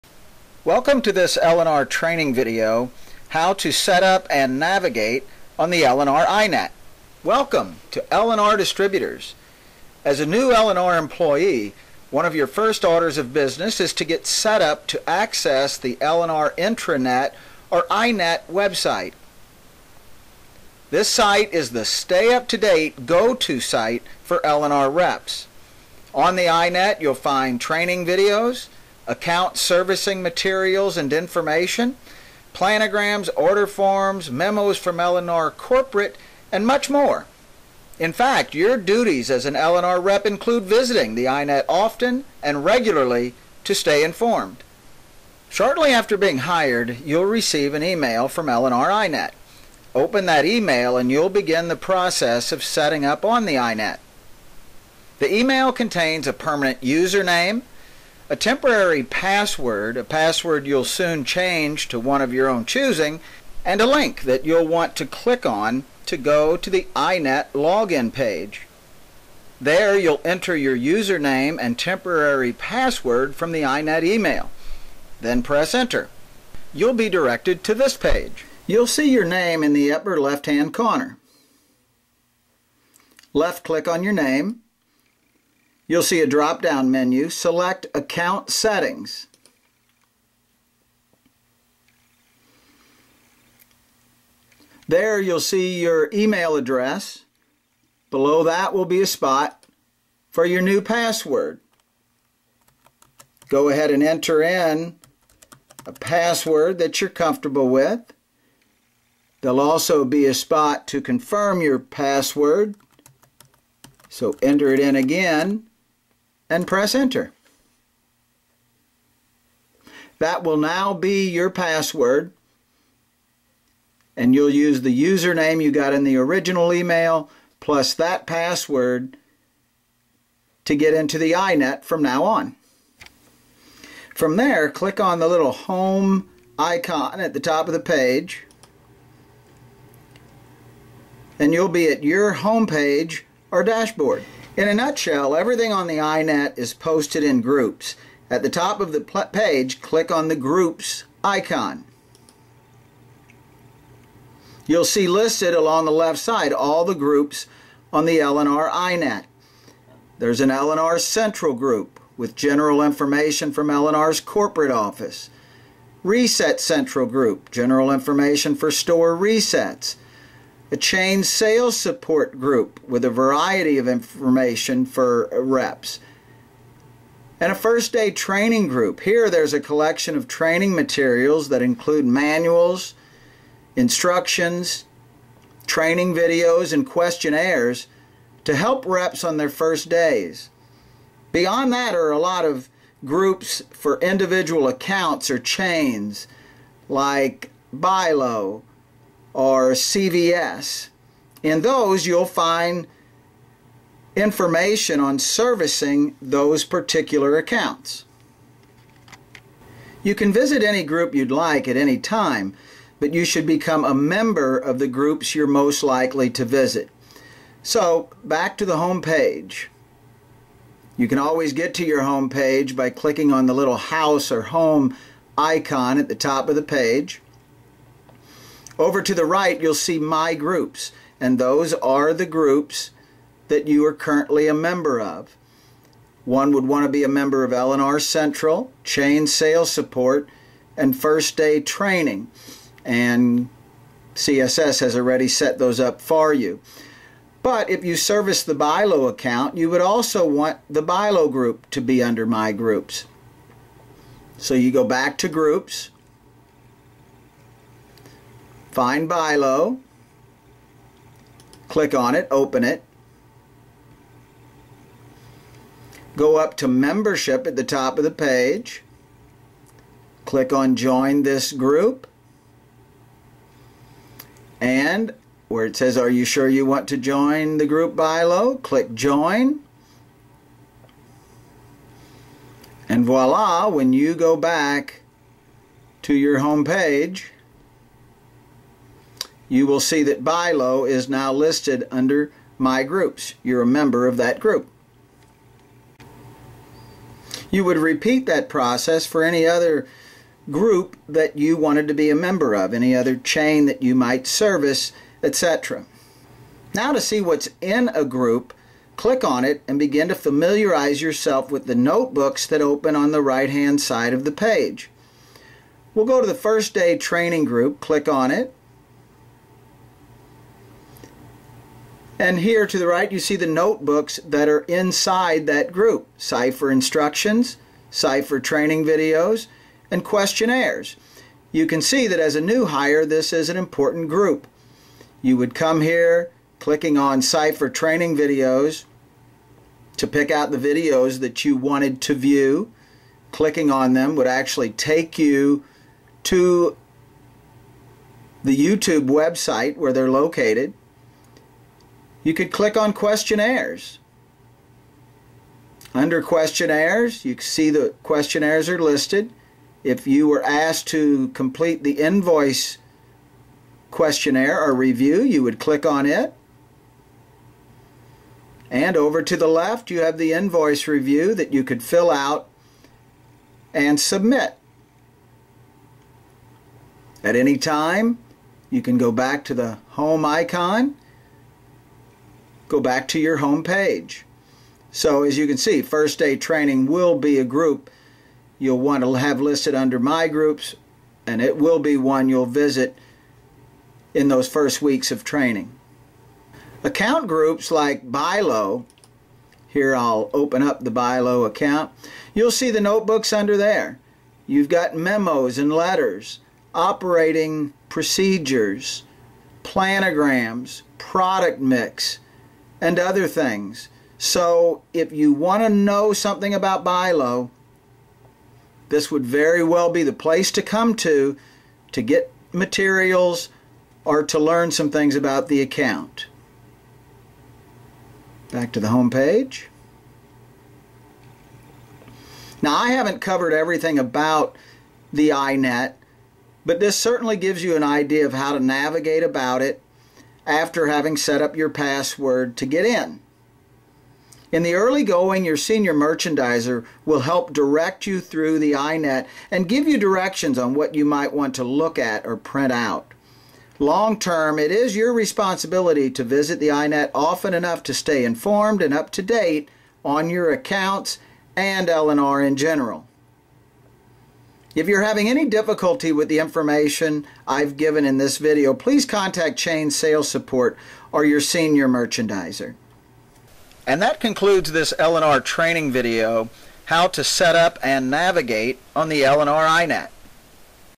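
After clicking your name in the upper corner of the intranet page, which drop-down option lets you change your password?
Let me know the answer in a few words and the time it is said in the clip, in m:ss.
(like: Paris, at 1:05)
Account Settings, at 1:27.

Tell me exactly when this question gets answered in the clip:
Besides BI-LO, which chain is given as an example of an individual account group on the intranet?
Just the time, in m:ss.
3:19.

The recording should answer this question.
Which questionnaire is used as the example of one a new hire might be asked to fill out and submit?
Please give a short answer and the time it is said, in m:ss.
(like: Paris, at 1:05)
Invoice questionnaire, at 6:01.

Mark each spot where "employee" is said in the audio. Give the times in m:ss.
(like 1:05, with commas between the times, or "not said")
0:10.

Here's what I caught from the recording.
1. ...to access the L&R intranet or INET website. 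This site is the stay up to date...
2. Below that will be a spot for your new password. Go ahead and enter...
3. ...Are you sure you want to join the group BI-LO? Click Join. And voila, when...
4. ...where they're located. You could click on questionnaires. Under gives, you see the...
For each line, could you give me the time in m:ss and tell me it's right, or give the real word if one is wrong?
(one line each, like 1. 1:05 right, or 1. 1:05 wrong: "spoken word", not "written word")
1. 0:14 right
2. 1:38 right
3. 4:35 right
4. 5:49 wrong: "questionnaires", not "gives".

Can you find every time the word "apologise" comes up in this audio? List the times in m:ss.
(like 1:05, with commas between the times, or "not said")
not said.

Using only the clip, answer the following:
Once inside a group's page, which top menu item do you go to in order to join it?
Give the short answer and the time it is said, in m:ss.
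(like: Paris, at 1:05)
Membership, at 4:26.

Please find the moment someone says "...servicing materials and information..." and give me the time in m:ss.
0:29.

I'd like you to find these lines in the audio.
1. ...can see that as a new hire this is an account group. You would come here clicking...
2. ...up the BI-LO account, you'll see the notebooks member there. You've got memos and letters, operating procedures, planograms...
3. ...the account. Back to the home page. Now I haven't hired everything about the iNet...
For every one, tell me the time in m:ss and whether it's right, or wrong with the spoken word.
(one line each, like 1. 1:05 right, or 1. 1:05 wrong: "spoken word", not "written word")
1. 5:31 wrong: "important", not "account"
2. 6:40 wrong: "under", not "member"
3. 7:05 wrong: "covered", not "hired".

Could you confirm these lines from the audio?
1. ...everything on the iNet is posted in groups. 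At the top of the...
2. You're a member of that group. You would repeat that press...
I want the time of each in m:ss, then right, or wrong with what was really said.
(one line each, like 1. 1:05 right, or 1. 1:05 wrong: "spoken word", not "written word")
1. 2:25 right
2. 4:53 wrong: "process", not "press".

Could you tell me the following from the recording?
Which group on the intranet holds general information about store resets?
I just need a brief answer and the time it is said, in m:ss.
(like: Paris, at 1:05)
Reset Central, at 2:46.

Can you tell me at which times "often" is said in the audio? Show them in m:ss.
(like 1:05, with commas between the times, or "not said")
0:41, 7:37.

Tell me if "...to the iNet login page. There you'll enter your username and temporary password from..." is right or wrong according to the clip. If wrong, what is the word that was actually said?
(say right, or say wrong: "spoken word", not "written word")
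right.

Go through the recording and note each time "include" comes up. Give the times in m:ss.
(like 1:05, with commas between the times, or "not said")
0:40, 3:01.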